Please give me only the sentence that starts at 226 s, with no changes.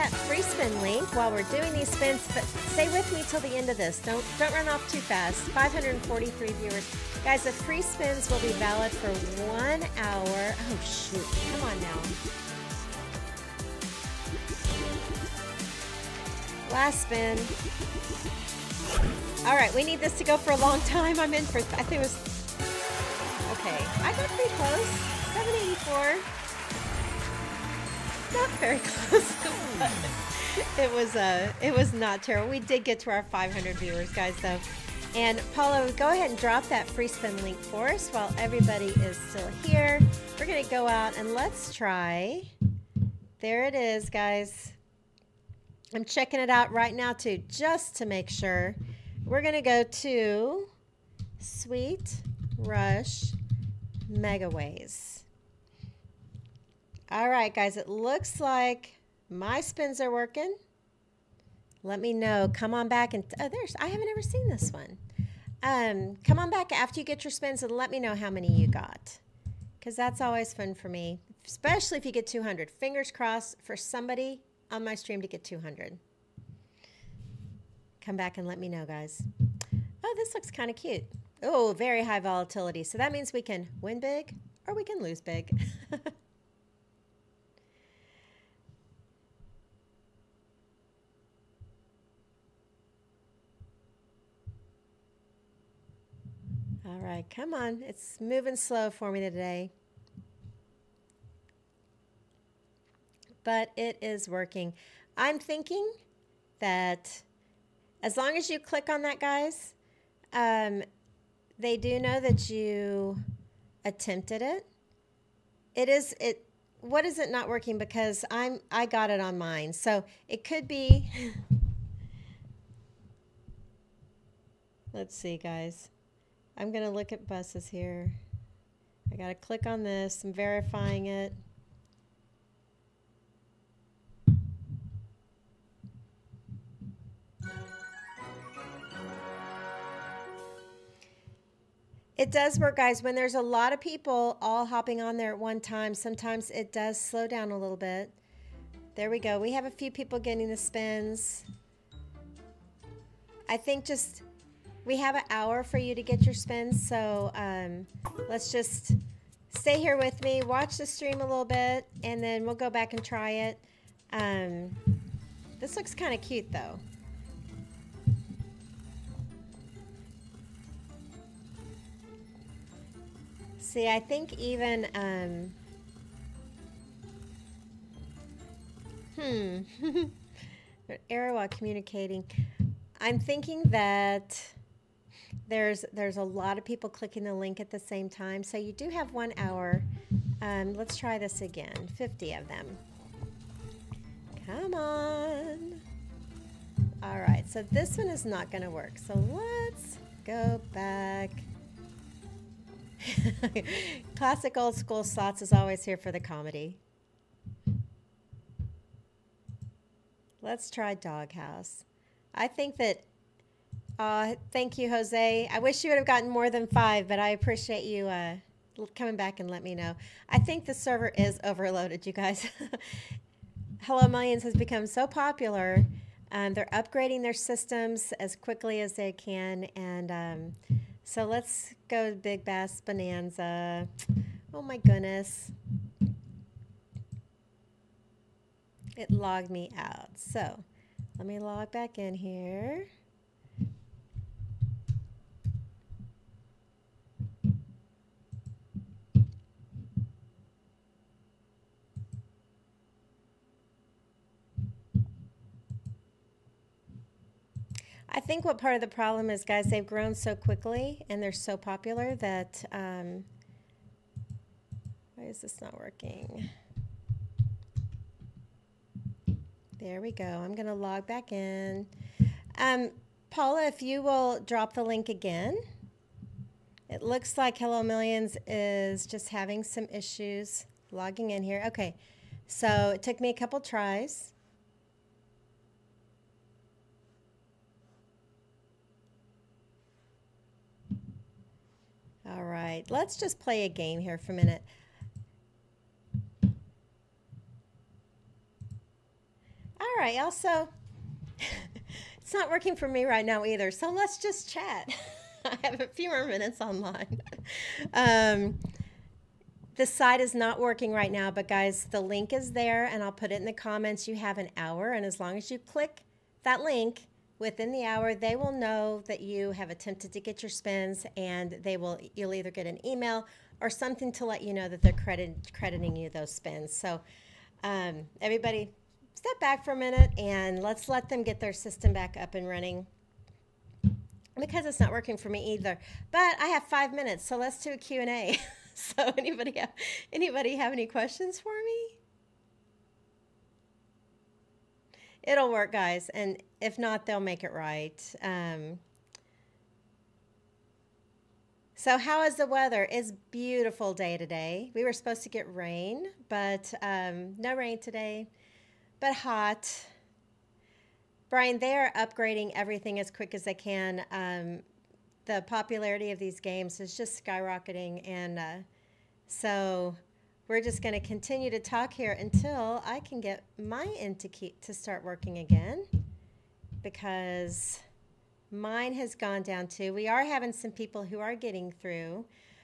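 Um, they're upgrading their systems as quickly as they can, and um, so let's go to Big Bass Bonanza.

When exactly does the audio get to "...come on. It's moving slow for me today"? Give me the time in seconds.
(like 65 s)
97 s.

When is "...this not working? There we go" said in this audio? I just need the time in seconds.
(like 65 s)
265 s.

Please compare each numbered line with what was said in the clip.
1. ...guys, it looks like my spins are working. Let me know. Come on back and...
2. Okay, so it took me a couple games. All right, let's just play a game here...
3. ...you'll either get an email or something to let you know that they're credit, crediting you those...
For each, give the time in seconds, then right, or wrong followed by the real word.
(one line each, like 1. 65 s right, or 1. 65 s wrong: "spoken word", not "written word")
1. 57 s right
2. 281 s wrong: "tries", not "games"
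3. 322 s right.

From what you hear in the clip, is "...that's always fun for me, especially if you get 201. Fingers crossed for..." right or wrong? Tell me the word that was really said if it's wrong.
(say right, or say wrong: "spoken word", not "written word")
wrong: "200", not "201".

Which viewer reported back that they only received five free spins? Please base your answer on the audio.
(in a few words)
Jose.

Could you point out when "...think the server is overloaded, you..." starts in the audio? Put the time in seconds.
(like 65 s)
220 s.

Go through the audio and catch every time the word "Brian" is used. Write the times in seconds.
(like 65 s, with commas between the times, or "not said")
361 s.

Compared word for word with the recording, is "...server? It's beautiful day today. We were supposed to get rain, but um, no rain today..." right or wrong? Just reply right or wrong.
wrong.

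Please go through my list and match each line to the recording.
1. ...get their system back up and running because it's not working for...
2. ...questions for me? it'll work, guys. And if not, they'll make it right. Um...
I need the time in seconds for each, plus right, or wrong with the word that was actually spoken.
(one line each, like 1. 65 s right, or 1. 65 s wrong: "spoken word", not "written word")
1. 331 s right
2. 340 s right.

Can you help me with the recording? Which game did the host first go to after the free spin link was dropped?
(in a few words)
Sweet Rush Megaways.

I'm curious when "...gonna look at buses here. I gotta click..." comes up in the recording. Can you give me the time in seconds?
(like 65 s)
126 s.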